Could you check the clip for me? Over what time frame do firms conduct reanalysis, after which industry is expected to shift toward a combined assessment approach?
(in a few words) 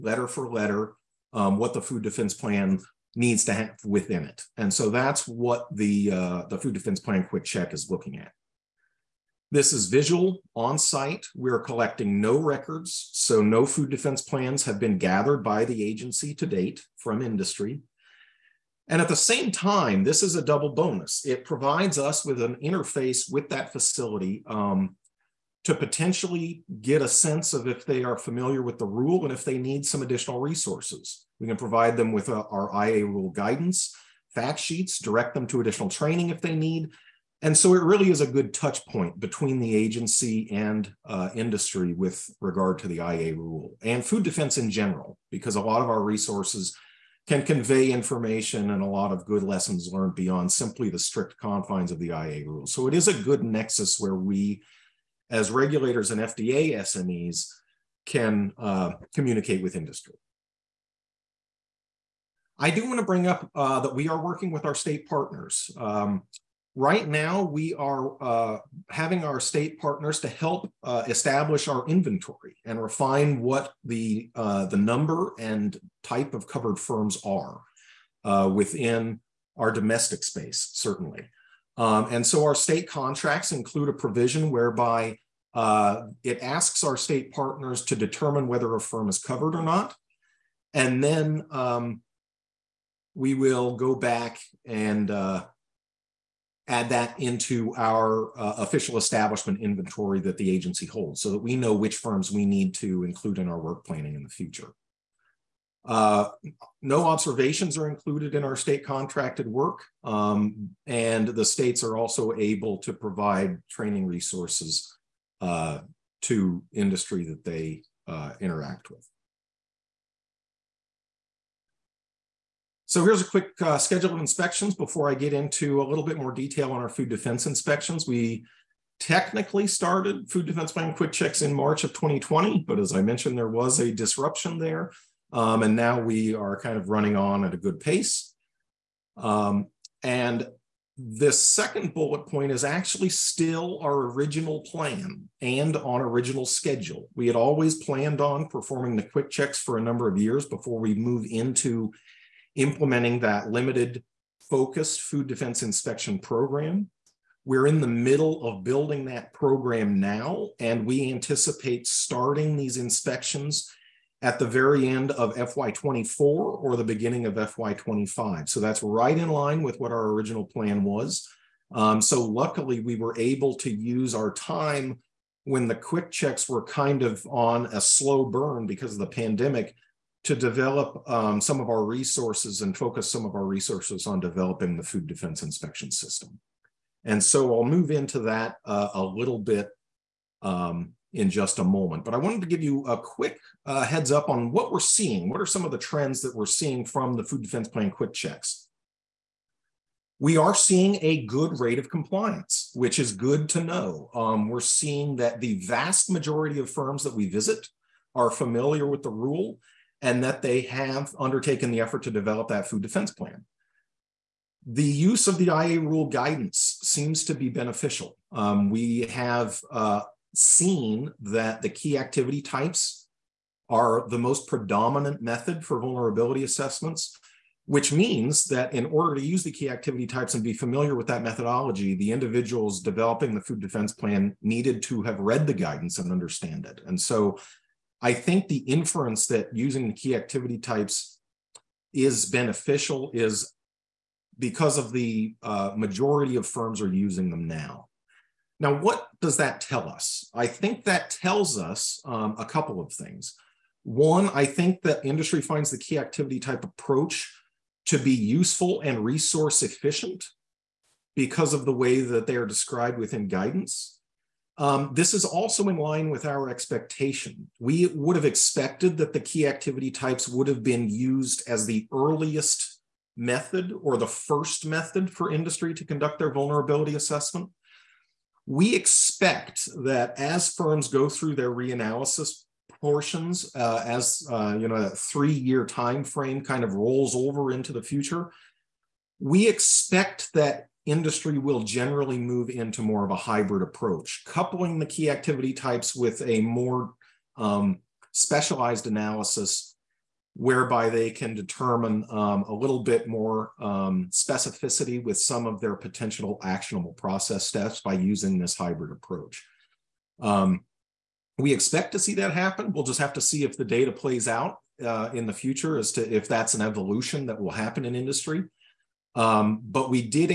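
3 years.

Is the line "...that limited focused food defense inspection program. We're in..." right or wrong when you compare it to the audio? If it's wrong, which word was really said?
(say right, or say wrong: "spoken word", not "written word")
right.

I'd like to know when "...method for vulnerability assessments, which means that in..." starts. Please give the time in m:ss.
3:45.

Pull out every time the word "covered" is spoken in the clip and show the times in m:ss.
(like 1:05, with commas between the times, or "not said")
1:16, 1:29.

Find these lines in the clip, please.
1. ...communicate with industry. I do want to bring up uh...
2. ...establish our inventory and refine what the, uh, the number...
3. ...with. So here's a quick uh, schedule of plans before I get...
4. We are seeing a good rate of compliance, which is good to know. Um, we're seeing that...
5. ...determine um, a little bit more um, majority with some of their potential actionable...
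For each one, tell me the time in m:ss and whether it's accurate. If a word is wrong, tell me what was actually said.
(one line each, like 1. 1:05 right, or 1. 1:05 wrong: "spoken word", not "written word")
1. 0:59 right
2. 1:11 right
3. 1:58 wrong: "inspections", not "plans"
4. 3:20 right
5. 5:01 wrong: "specificity", not "majority".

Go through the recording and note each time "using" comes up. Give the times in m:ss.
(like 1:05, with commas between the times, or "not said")
3:59, 4:06, 5:07.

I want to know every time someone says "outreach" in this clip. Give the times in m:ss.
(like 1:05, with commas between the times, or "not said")
not said.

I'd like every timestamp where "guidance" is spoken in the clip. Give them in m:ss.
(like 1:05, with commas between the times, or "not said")
0:33, 3:36, 3:55, 4:23.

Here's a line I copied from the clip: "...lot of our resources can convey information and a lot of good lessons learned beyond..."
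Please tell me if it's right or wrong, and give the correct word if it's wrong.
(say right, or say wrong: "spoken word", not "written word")
right.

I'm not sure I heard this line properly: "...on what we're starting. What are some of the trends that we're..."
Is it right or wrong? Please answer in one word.
wrong.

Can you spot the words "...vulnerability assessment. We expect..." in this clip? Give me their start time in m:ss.
4:36.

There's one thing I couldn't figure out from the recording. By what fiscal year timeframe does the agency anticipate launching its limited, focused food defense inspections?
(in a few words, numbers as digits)
end of FY24 or beginning of FY25.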